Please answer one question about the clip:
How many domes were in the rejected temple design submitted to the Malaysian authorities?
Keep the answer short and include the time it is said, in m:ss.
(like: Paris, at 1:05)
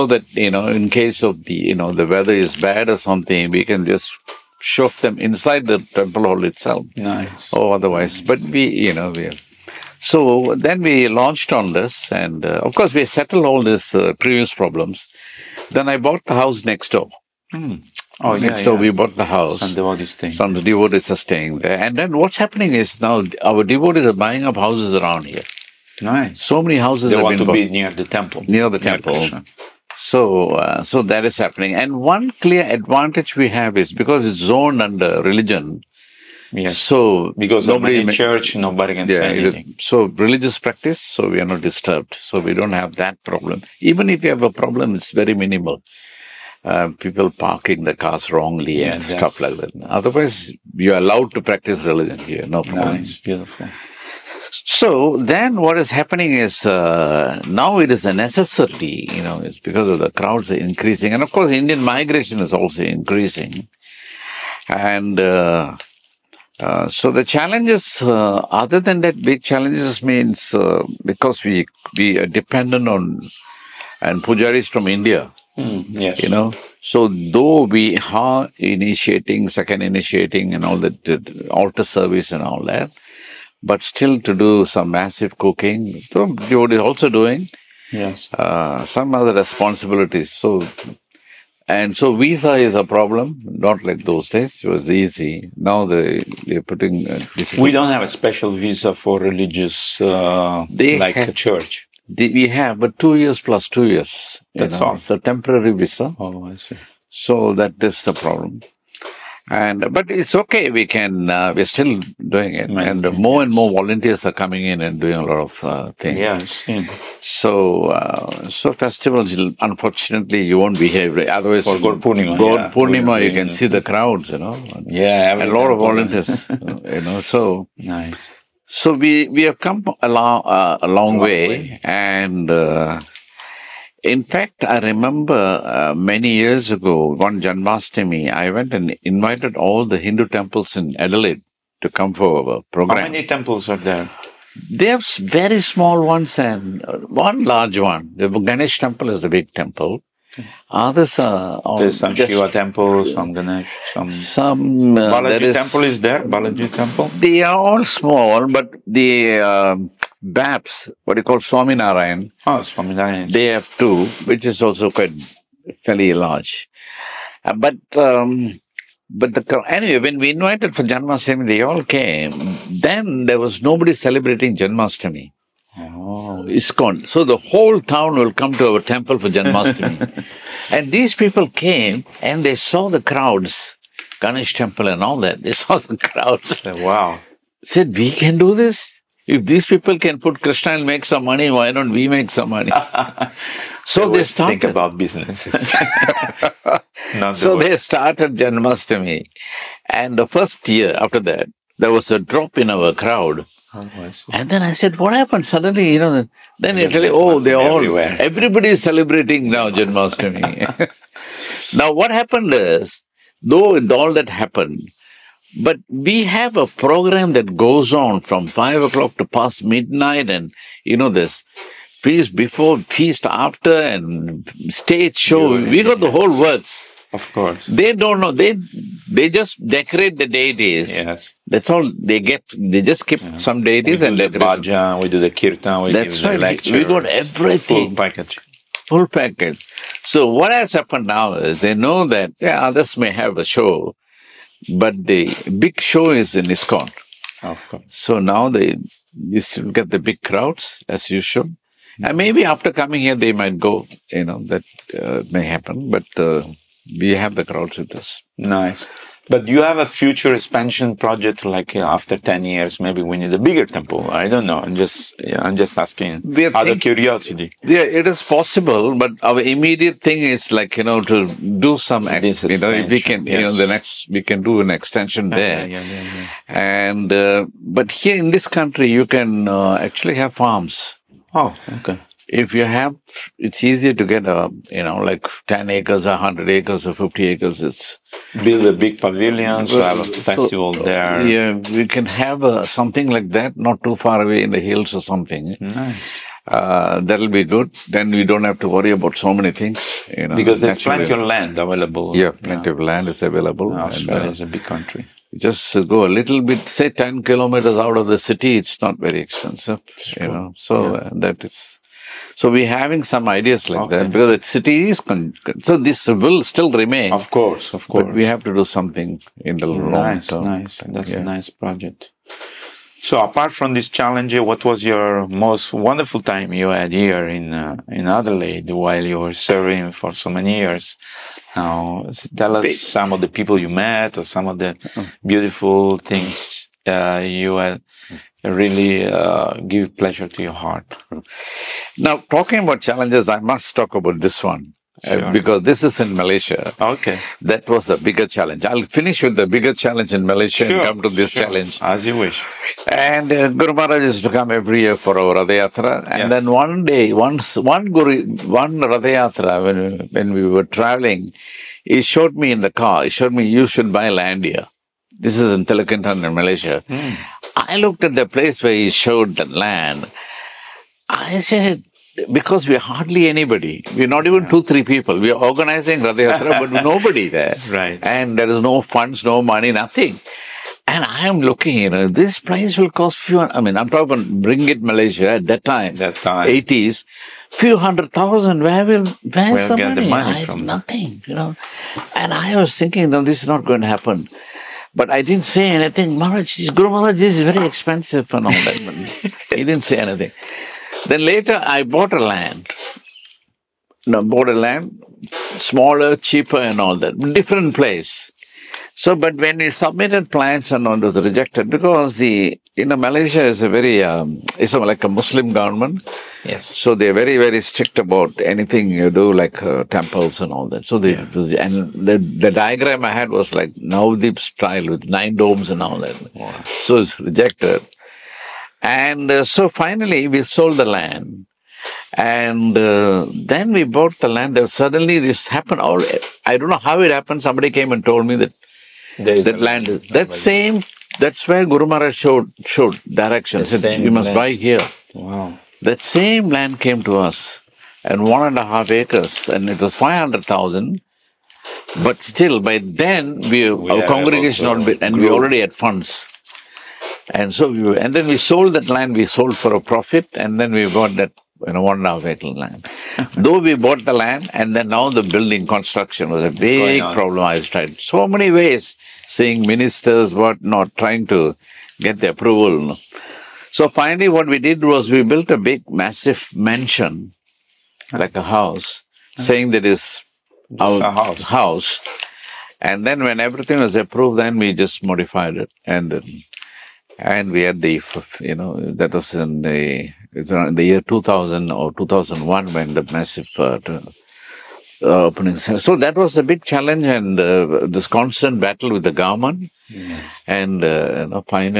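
9, at 7:05.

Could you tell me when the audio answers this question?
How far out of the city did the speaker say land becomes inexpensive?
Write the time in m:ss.
5:06.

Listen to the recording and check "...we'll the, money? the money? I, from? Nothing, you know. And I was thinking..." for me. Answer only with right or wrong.
right.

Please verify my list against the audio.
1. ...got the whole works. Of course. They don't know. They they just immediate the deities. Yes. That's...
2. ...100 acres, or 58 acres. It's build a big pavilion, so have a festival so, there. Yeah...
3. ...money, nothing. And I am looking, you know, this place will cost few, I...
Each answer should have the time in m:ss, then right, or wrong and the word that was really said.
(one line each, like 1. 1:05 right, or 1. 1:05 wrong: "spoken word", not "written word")
1. 3:45 wrong: "decorate", not "immediate"
2. 4:46 wrong: "50", not "58"
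3. 6:19 right.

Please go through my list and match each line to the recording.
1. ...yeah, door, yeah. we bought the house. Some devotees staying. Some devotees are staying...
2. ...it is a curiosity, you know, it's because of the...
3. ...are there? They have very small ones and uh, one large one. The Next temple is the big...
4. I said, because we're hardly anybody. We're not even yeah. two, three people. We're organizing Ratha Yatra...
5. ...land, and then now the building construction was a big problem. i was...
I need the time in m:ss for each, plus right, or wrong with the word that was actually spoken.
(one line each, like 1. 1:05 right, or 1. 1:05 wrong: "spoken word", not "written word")
1. 0:18 right
2. 0:57 wrong: "necessity", not "curiosity"
3. 2:23 wrong: "Ganesh", not "Next"
4. 6:11 right
5. 7:44 right.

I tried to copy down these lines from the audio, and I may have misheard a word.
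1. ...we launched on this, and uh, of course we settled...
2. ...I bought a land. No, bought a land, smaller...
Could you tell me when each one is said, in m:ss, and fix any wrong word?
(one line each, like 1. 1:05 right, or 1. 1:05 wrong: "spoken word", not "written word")
1. 0:10 right
2. 6:41 right.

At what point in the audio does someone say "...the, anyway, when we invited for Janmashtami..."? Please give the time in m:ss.
2:49.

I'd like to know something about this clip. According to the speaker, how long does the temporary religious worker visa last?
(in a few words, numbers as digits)
2 years plus 2 years.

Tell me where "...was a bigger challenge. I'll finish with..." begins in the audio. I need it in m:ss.
5:47.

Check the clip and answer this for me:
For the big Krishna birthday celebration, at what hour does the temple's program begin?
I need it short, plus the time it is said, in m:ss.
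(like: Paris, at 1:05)
5 o'clock, at 3:38.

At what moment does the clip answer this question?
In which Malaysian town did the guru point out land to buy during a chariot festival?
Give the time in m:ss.
6:05.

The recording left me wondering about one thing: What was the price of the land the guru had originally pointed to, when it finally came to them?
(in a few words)
500,000.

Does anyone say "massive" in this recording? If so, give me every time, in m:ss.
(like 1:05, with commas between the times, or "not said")
1:24, 7:55, 8:13.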